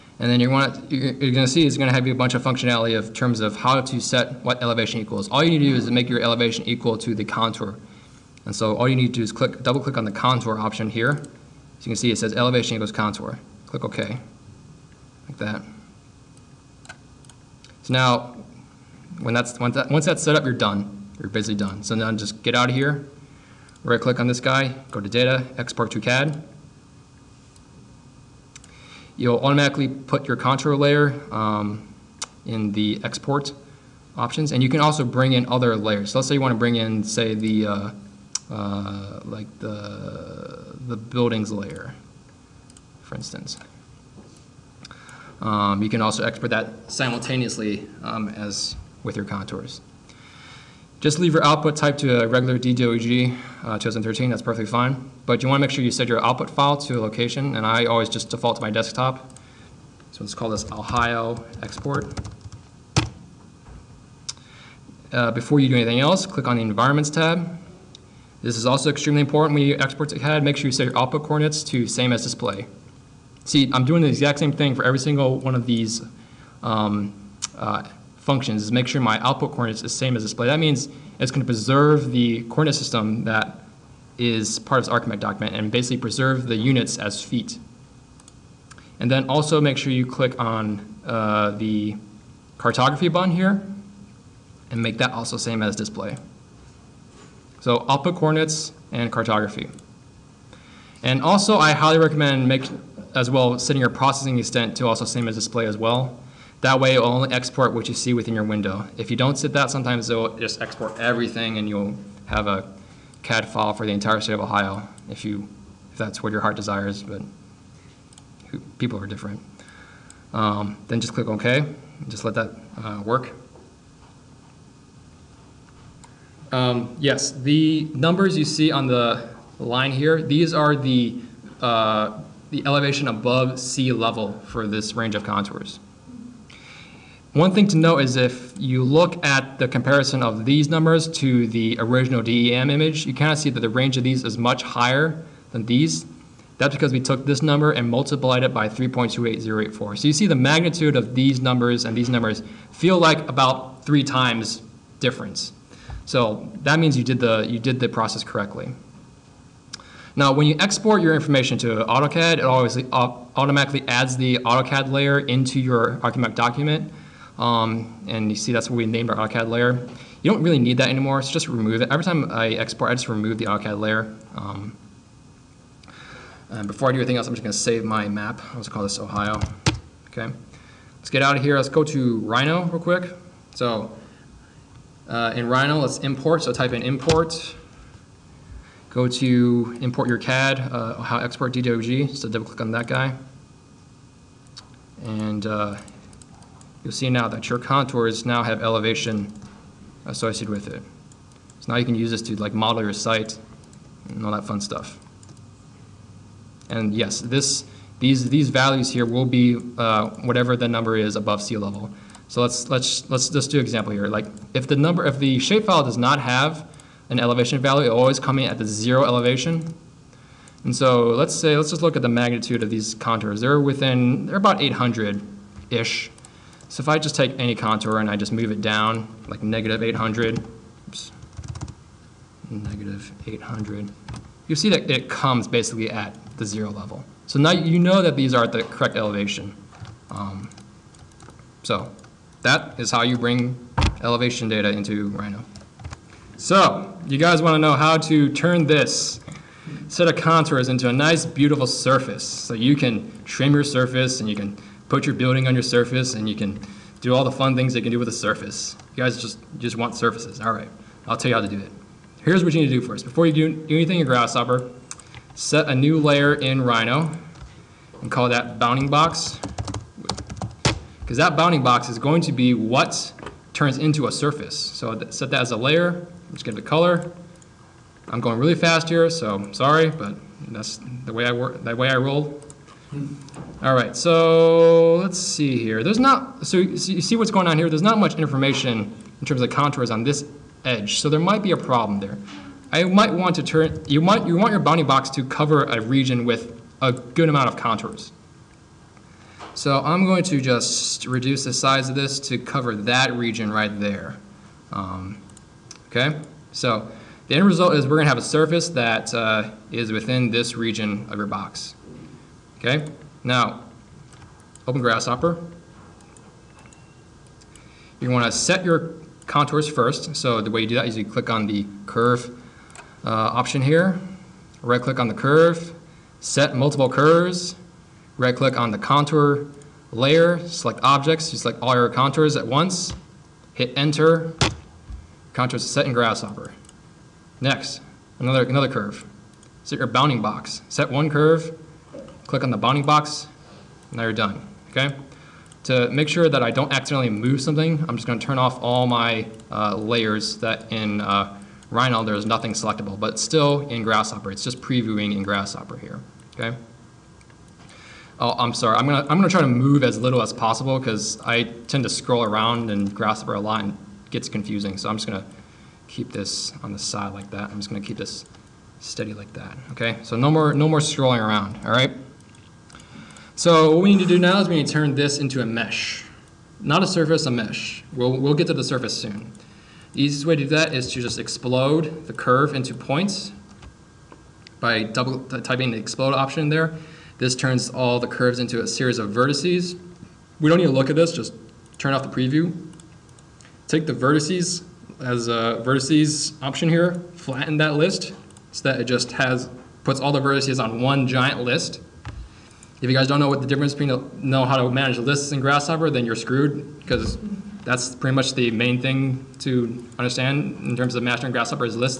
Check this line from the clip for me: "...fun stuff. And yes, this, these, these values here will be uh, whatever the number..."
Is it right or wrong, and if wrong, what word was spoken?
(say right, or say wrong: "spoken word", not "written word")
right.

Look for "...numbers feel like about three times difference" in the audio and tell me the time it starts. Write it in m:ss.
2:32.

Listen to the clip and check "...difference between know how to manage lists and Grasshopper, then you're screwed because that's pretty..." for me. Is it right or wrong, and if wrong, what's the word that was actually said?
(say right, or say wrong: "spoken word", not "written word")
right.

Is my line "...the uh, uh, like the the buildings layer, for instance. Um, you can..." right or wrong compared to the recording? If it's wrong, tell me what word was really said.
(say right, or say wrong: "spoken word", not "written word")
right.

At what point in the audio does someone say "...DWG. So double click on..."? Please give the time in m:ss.
3:11.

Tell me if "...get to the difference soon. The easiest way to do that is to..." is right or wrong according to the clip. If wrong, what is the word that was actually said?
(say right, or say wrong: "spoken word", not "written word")
wrong: "surface", not "difference".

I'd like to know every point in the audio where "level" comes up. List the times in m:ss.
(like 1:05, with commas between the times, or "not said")
2:13, 3:31, 3:56.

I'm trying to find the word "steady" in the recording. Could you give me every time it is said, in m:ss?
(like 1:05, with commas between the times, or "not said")
6:08.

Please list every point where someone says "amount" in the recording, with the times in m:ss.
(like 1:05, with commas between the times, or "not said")
4:57.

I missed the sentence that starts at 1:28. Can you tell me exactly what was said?
And then also make sure you click on uh, the cartography button here and make that also same as display.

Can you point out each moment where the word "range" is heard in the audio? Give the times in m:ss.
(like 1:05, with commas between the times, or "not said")
2:14, 2:23.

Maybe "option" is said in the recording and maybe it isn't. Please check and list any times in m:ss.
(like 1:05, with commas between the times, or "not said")
0:10, 0:34, 5:23, 6:26, 6:36.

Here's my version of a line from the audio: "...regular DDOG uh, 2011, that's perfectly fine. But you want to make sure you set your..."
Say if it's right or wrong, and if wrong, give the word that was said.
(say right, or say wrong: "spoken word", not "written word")
wrong: "2013", not "2011".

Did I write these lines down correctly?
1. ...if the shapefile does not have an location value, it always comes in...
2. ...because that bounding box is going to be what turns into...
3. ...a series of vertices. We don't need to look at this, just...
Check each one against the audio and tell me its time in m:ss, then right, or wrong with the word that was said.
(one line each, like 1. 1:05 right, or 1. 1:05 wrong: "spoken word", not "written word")
1. 3:35 wrong: "elevation", not "location"
2. 4:31 right
3. 6:28 right.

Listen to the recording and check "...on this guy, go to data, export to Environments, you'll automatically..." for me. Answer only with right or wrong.
wrong.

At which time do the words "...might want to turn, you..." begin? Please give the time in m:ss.
4:52.